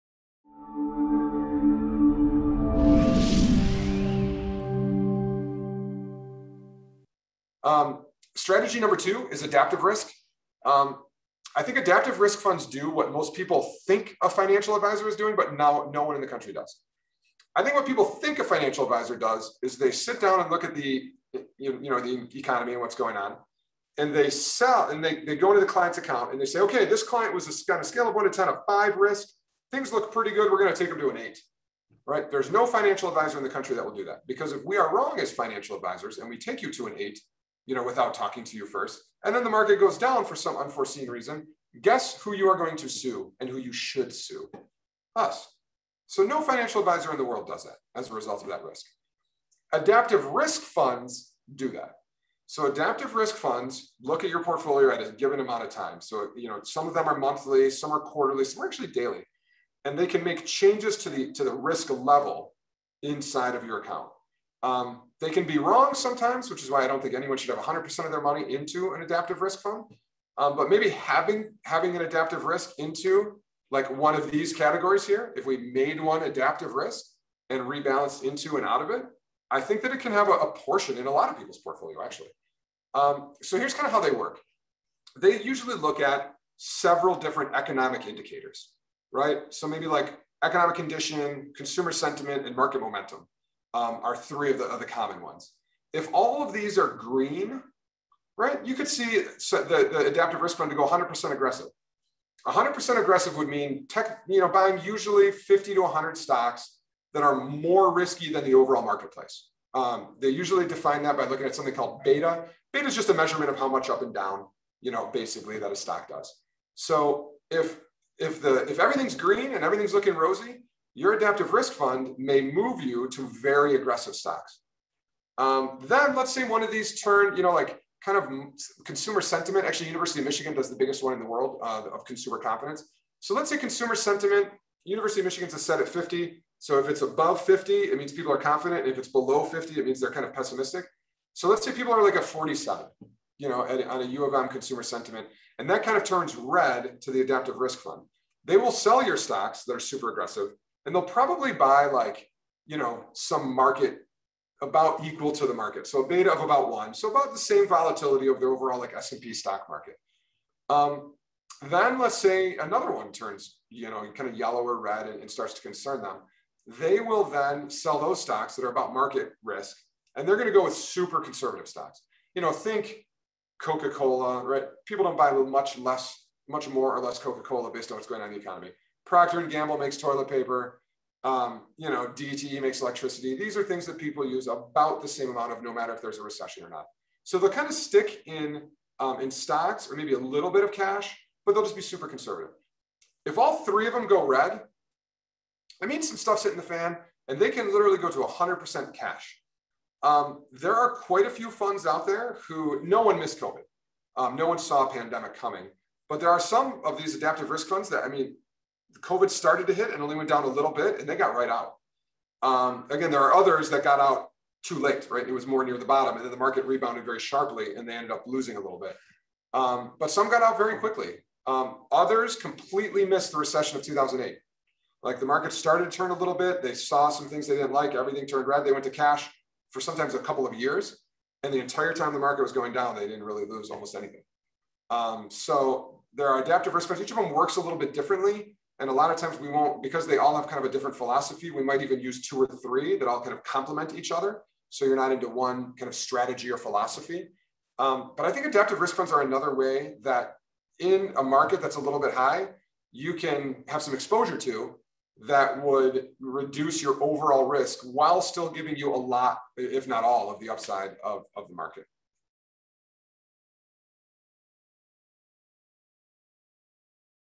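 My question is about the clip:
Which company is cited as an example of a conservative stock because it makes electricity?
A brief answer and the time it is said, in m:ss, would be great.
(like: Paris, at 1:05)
DTE, at 3:02.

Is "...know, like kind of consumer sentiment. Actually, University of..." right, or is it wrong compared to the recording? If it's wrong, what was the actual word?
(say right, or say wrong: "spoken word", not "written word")
right.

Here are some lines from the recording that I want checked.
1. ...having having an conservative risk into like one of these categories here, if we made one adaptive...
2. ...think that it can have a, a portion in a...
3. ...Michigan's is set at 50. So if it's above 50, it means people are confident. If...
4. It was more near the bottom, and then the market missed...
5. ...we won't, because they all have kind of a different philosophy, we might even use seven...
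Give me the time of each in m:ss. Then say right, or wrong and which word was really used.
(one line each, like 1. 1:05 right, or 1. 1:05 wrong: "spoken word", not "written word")
1. 1:10 wrong: "adaptive", not "conservative"
2. 1:19 right
3. 2:15 right
4. 3:35 wrong: "rebounded", not "missed"
5. 3:59 wrong: "two", not "seven".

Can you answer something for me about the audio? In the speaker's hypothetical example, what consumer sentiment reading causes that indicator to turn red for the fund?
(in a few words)
47.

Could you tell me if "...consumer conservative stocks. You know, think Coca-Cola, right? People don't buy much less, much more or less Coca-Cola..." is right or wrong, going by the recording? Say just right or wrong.
wrong.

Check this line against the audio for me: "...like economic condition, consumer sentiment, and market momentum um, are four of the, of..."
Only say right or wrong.
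wrong.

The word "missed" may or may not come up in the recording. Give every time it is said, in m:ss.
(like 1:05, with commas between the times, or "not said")
3:23, 3:43.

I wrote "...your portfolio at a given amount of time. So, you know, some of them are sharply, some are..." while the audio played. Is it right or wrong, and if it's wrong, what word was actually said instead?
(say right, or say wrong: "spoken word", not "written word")
wrong: "monthly", not "sharply".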